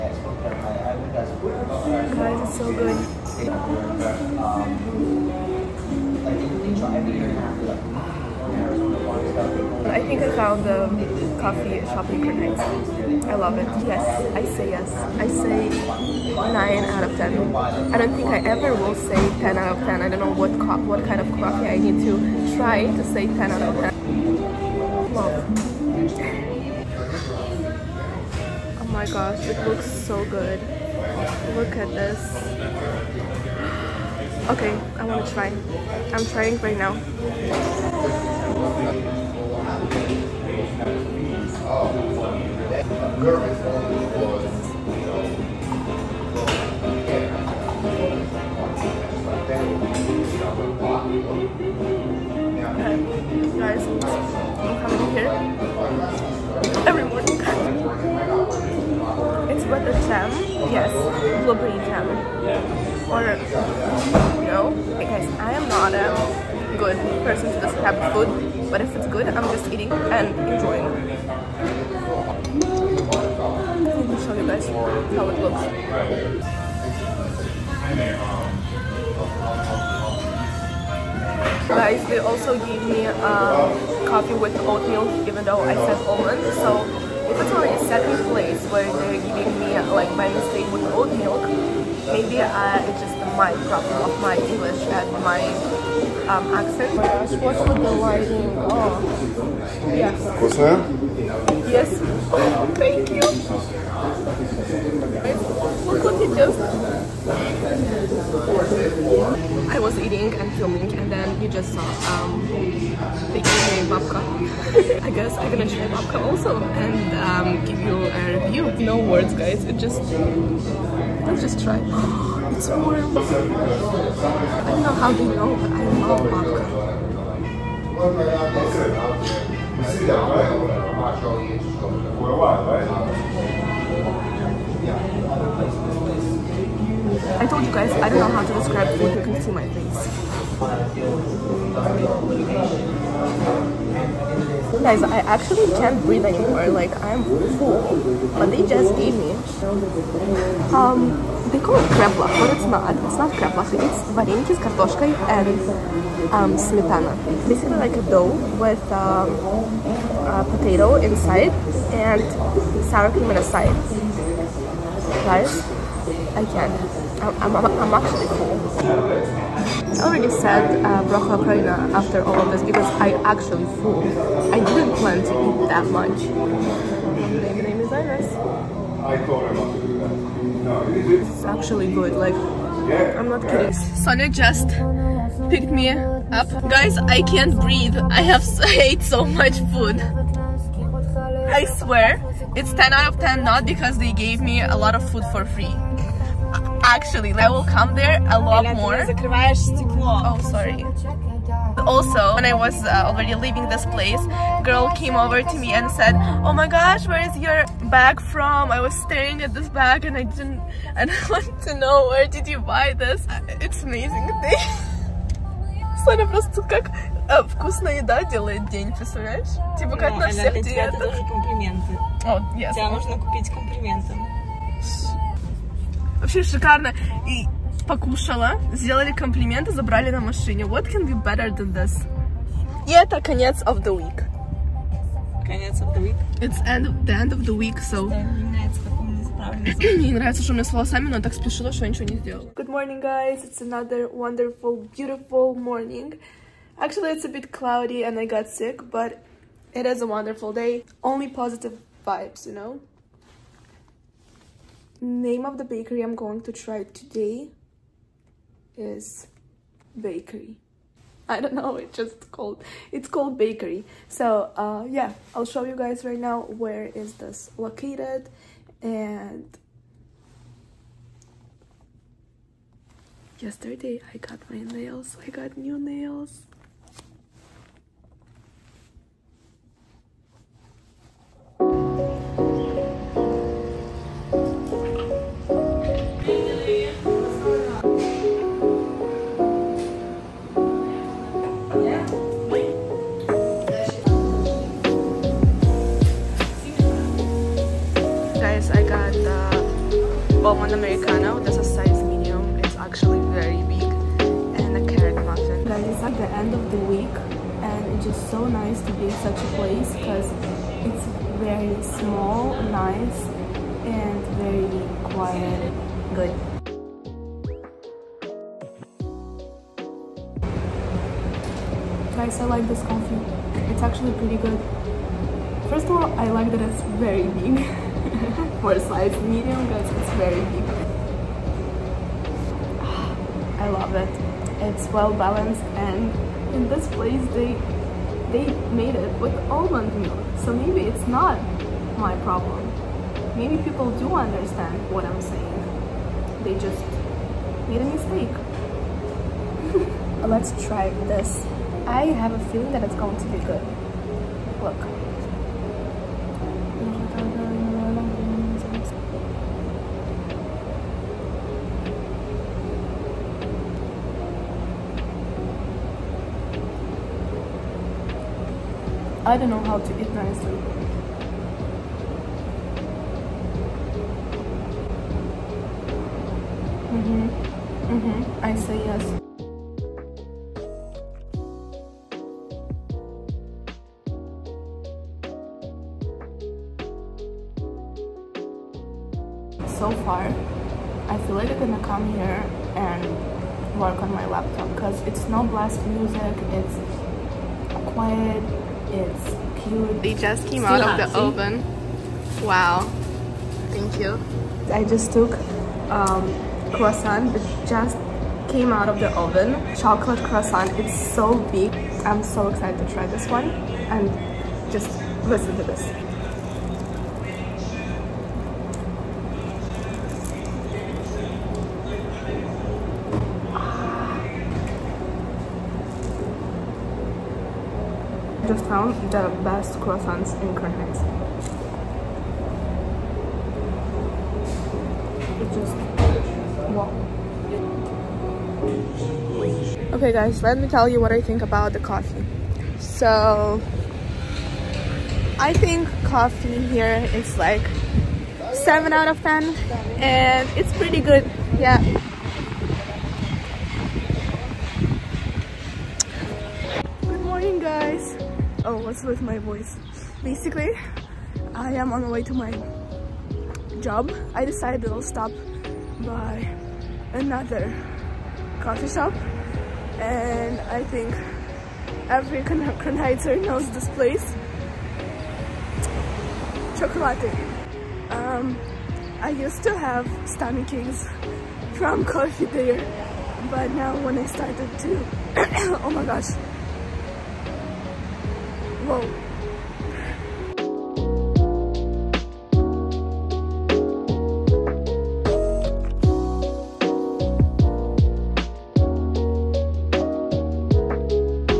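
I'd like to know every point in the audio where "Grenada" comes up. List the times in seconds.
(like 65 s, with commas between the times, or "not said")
12 s.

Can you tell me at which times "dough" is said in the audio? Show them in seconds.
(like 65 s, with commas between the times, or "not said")
158 s.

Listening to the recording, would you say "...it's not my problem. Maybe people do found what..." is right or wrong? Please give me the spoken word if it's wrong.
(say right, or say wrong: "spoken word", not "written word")
wrong: "understand", not "found".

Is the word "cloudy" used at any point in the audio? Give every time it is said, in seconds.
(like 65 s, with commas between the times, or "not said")
247 s.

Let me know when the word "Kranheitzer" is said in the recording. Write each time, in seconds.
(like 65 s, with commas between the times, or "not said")
472 s.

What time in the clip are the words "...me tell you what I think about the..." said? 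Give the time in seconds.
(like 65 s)
440 s.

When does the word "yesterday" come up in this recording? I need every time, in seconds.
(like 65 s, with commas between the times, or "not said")
273 s.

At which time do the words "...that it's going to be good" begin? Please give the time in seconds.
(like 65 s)
352 s.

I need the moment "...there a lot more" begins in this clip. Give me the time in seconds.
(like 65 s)
197 s.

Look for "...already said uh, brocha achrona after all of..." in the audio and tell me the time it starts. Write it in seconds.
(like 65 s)
170 s.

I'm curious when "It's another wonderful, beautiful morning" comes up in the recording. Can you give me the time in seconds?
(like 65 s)
243 s.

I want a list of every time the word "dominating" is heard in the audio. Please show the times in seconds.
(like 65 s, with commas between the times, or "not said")
not said.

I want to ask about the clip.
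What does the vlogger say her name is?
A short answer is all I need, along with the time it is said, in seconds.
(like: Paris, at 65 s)
Iris, at 177 s.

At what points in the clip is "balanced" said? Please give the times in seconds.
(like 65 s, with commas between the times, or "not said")
335 s.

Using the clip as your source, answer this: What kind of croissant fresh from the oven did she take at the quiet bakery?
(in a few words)
Chocolate croissant.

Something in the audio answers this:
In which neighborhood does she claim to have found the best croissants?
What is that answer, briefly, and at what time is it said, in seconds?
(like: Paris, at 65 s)
Crown Heights, at 430 s.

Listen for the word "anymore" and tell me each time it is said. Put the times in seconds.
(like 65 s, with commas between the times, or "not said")
146 s.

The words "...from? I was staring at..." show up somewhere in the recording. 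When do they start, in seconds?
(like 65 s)
208 s.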